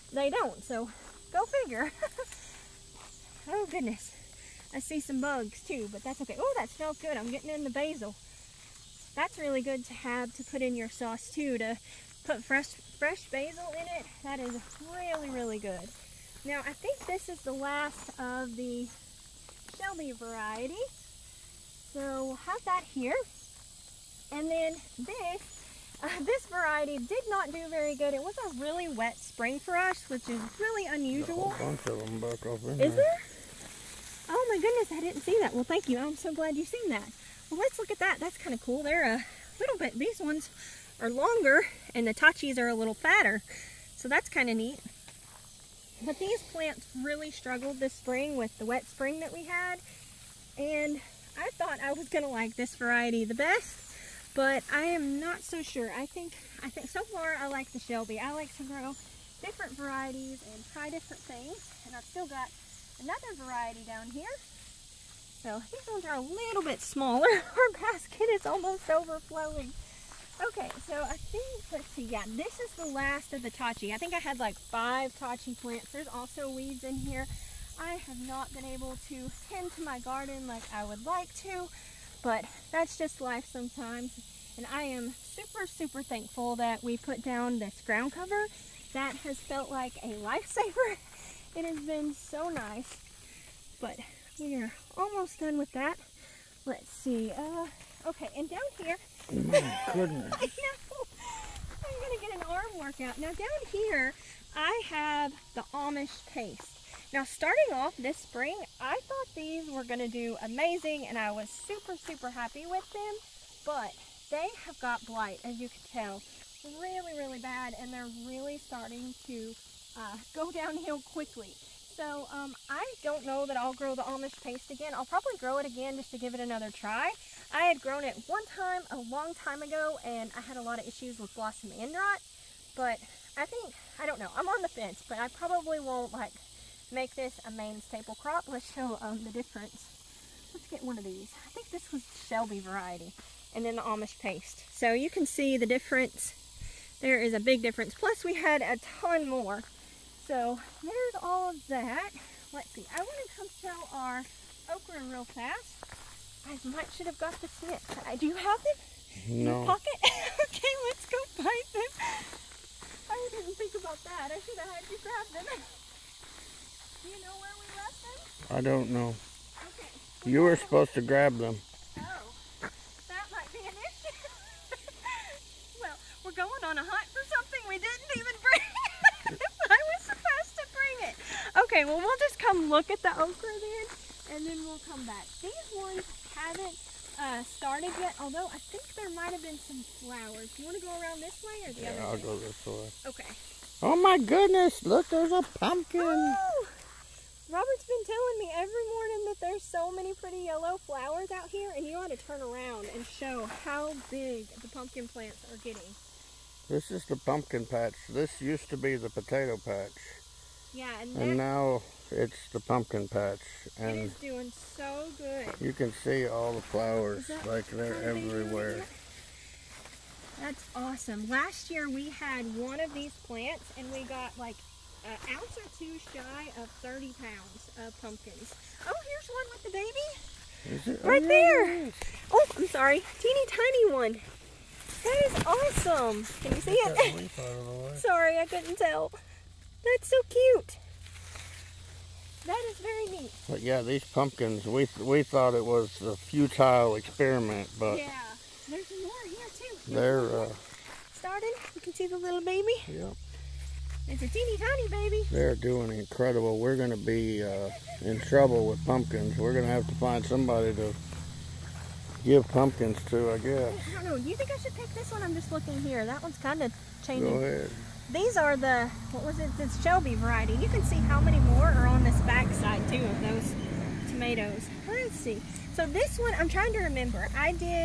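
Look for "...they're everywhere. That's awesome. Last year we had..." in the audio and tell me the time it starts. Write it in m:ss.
3:37.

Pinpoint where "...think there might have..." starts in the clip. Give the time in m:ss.
3:08.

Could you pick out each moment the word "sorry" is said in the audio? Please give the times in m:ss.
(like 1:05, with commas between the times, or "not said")
3:52, 3:57.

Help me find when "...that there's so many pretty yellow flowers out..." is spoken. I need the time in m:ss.
3:19.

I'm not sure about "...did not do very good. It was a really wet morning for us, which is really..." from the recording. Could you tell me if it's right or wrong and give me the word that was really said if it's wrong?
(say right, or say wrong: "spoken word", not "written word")
wrong: "spring", not "morning".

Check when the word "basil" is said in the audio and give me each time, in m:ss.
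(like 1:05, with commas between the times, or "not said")
0:07, 0:13.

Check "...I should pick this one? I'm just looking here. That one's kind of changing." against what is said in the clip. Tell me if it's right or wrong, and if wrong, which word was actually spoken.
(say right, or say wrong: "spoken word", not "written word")
right.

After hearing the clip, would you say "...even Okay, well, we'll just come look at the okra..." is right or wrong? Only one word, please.
right.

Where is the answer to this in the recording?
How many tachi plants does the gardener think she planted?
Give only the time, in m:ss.
1:14.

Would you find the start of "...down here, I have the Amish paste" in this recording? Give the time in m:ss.
1:43.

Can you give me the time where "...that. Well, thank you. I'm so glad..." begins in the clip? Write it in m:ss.
0:35.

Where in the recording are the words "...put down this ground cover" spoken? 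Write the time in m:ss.
1:26.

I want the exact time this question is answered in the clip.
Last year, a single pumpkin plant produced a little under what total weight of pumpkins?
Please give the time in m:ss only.
3:46.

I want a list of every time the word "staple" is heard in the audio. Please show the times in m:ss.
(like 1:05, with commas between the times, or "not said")
2:17.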